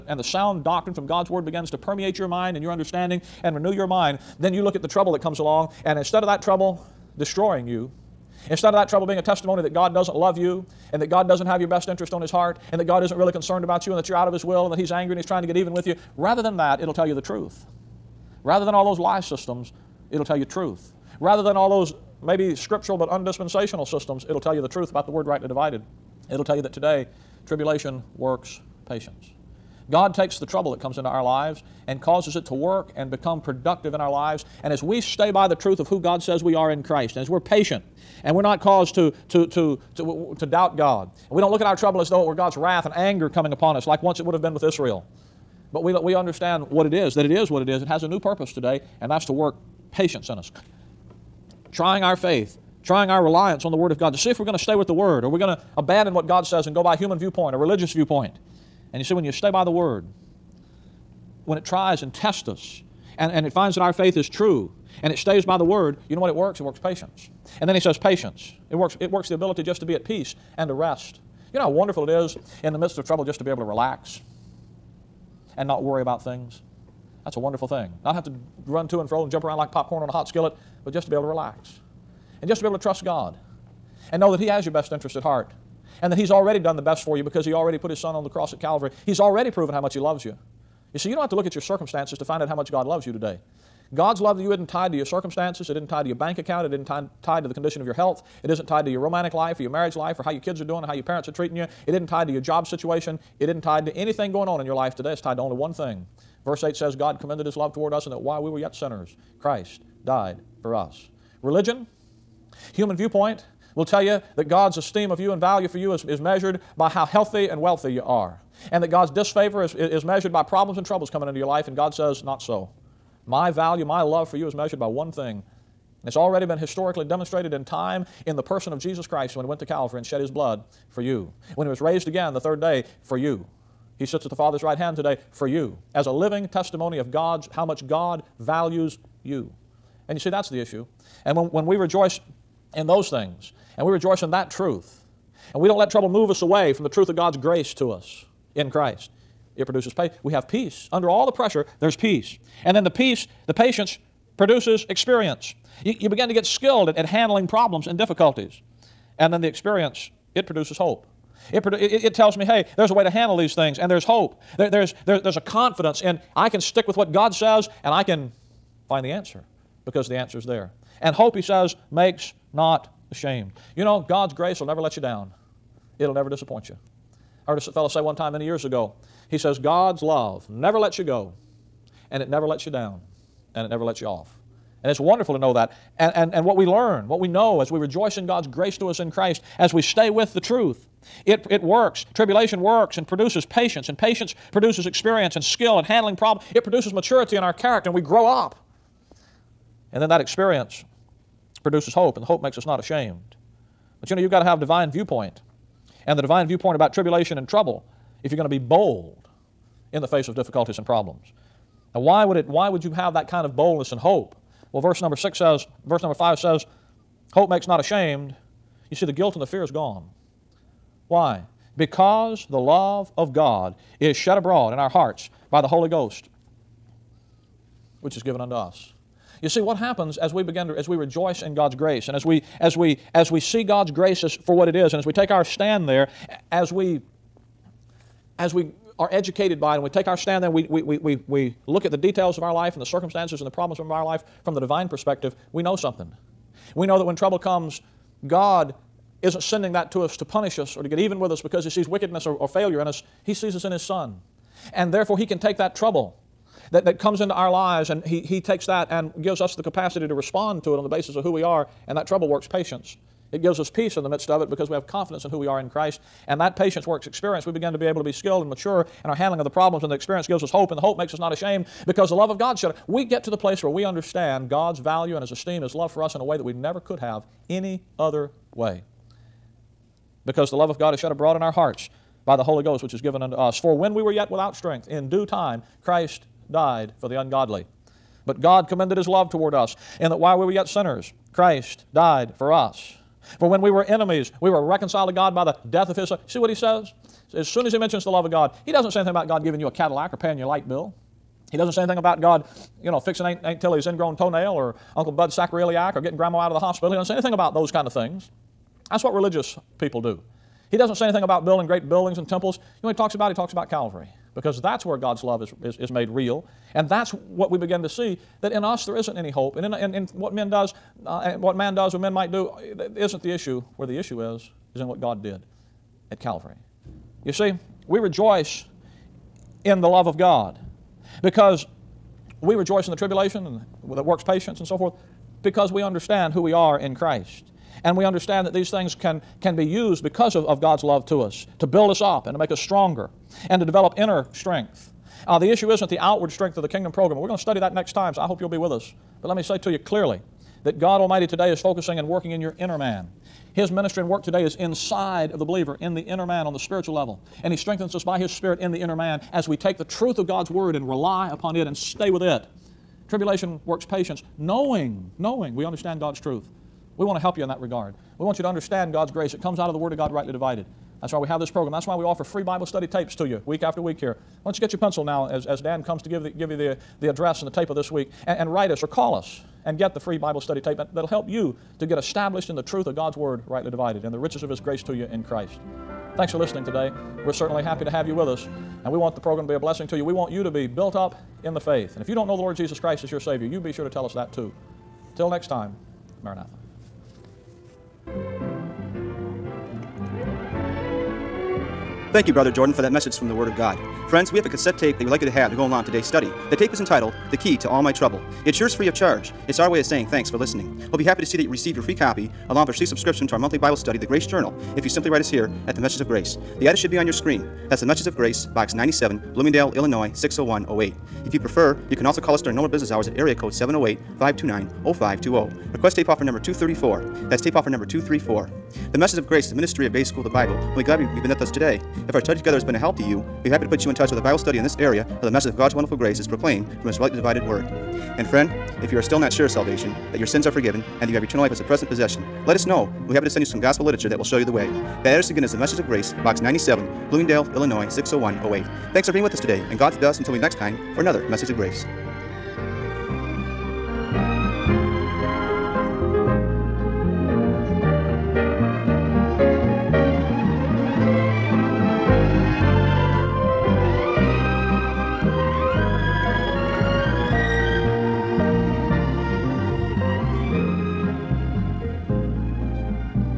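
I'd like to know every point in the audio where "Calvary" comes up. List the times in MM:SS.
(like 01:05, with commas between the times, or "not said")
01:28, 02:09, 05:13, 05:26.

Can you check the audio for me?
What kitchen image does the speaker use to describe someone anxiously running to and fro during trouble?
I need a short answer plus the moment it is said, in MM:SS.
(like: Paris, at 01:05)
popcorn on a hot skillet, at 01:19.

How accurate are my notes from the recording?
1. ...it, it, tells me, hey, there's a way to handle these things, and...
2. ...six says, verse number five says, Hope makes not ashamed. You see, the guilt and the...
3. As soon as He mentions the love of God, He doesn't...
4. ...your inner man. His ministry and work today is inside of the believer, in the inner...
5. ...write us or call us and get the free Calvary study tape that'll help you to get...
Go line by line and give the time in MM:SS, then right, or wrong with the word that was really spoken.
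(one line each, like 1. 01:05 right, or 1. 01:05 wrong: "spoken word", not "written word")
1. 02:41 right
2. 03:35 right
3. 04:57 right
4. 05:52 right
5. 06:18 wrong: "Bible", not "Calvary".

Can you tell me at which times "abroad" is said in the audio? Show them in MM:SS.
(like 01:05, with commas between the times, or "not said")
03:44, 04:41.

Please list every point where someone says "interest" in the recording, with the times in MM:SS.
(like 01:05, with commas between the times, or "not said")
00:11, 01:24.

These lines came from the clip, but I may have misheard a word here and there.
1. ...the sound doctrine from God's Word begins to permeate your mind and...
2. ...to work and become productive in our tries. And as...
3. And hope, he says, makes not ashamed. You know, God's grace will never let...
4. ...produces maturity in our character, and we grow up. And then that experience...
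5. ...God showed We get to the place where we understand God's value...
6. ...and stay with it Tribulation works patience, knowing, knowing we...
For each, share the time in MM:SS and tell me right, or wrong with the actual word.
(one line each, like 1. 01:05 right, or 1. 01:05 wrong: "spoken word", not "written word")
1. 00:00 right
2. 00:32 wrong: "lives", not "tries"
3. 02:51 right
4. 03:16 right
5. 04:32 right
6. 06:01 right.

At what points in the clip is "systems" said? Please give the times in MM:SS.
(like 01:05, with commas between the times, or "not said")
00:19, 00:23.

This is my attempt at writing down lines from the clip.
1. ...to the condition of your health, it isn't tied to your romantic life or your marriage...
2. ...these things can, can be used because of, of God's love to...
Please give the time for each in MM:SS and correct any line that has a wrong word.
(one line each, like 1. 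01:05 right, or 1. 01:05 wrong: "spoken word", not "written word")
1. 01:37 right
2. 05:38 right.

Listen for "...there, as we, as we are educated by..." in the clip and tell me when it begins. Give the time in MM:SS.
03:55.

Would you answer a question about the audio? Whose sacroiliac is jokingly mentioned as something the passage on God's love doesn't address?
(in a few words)
Uncle Bud.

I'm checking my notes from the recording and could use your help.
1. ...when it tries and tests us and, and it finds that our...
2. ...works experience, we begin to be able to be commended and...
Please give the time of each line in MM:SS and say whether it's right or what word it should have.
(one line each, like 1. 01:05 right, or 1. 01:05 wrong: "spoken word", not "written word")
1. 01:01 right
2. 04:26 wrong: "skilled", not "commended".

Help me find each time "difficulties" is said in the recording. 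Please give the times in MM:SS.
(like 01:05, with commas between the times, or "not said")
02:37, 03:30.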